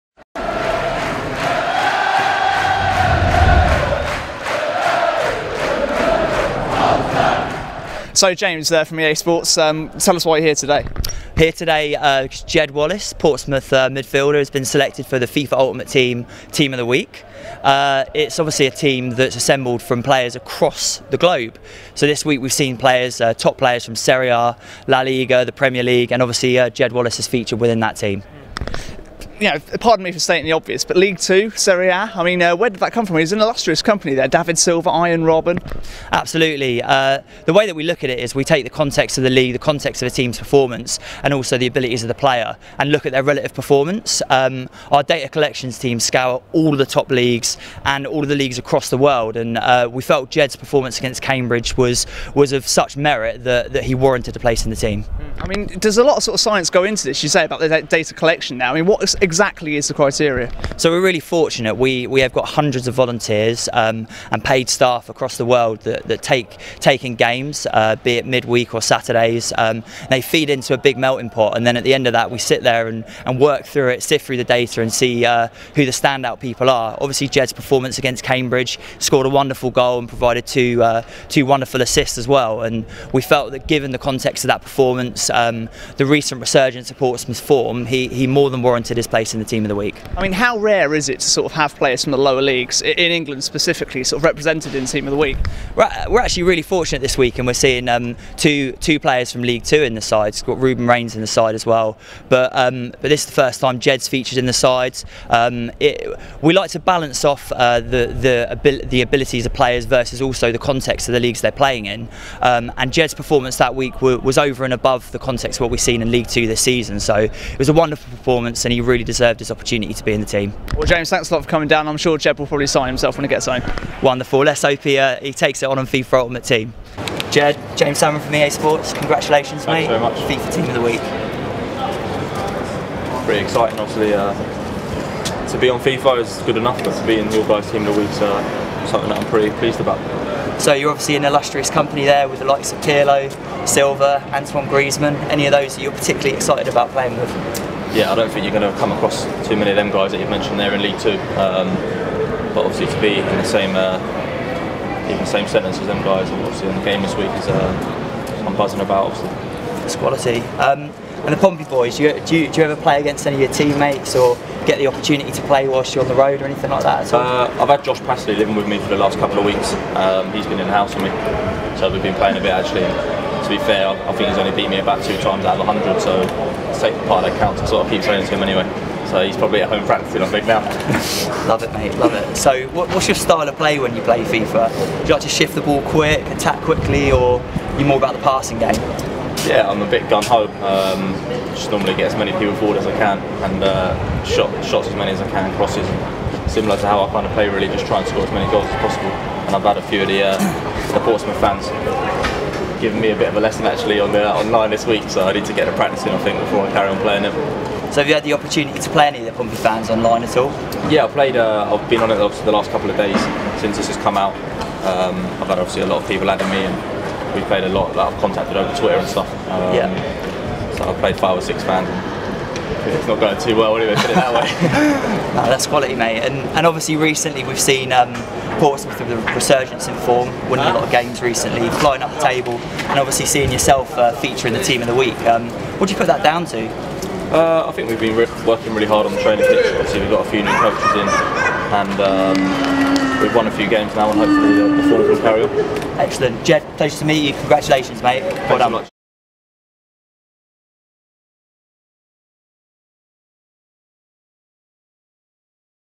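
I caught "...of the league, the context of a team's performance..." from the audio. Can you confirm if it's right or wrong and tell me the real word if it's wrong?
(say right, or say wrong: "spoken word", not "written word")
right.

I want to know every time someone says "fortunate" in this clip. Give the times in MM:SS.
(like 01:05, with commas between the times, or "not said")
01:01, 01:36.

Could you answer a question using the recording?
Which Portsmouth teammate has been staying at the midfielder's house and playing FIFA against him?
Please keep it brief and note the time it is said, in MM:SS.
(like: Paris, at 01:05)
Josh Passley, at 02:47.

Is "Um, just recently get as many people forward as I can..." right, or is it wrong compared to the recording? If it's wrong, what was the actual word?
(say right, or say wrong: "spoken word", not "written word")
wrong: "normally", not "recently".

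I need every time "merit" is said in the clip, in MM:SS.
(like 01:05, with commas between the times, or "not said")
00:52.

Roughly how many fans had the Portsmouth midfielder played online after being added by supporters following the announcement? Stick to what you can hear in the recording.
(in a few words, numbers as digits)
5 or 6.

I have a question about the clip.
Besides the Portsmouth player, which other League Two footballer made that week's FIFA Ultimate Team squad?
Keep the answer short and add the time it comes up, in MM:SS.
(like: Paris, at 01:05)
Ruben Raines, at 01:40.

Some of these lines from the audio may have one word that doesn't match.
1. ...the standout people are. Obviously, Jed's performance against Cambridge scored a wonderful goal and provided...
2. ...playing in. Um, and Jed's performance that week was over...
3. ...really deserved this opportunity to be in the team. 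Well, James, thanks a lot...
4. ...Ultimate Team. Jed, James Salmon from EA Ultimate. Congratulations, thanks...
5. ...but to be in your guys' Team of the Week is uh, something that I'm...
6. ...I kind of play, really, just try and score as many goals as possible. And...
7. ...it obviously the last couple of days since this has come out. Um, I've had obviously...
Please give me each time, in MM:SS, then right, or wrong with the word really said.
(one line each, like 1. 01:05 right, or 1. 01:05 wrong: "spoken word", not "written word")
1. 01:15 right
2. 01:51 right
3. 01:58 right
4. 02:06 wrong: "Sports", not "Ultimate"
5. 02:16 right
6. 03:17 right
7. 03:32 right.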